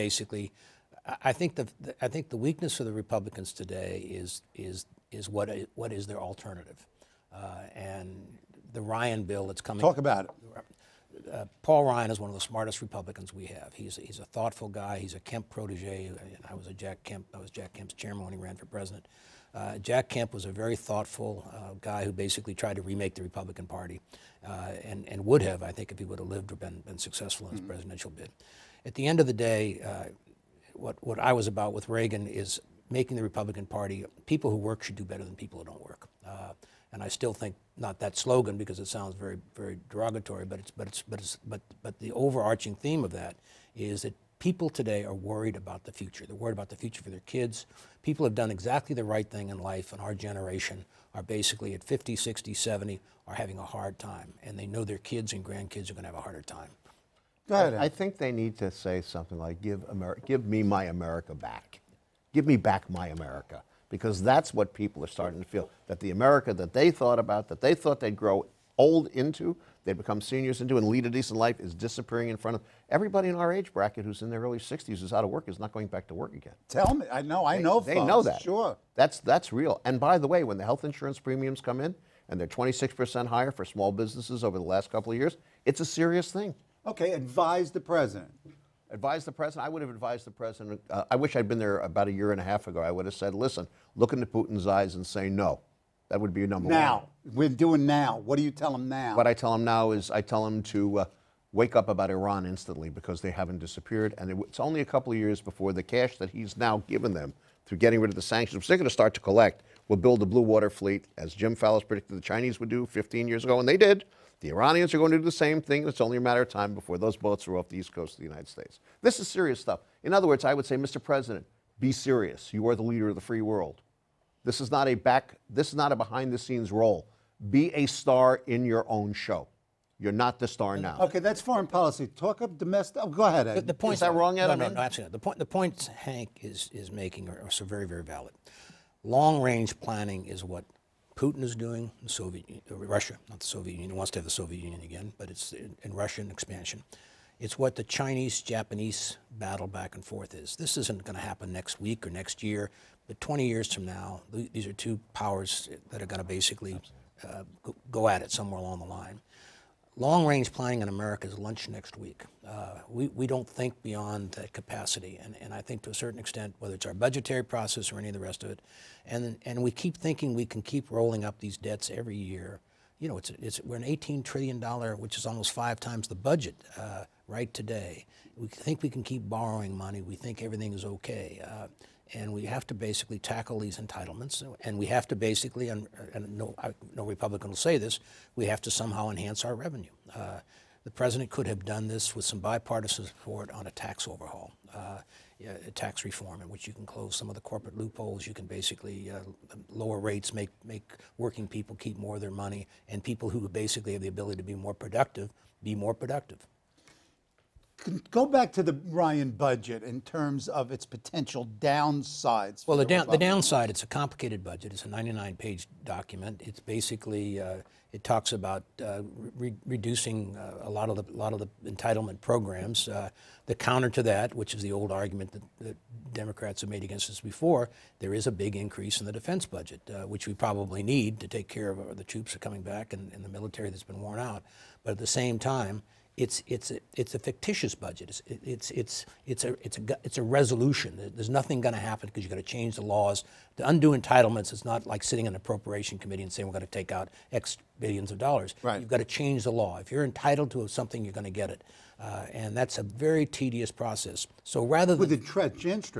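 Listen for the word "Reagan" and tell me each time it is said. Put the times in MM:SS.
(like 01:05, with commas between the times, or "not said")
00:31.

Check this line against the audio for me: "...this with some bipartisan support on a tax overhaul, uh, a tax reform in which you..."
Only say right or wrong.
right.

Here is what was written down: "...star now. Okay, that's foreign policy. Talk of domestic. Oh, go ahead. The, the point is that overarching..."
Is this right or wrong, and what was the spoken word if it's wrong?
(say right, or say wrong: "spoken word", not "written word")
wrong: "wrong", not "overarching".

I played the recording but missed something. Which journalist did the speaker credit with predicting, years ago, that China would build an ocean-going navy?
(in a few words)
Jim Fallows.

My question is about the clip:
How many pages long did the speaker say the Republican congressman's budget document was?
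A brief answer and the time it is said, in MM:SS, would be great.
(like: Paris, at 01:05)
99 pages, at 03:34.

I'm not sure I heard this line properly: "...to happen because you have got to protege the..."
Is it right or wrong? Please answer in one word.
wrong.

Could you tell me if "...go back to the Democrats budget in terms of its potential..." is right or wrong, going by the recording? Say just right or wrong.
wrong.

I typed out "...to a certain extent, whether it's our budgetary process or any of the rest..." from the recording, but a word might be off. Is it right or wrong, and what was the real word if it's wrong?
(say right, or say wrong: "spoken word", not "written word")
right.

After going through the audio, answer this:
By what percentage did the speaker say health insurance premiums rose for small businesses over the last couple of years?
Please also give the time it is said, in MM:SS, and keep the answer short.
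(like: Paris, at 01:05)
26 percent, at 01:22.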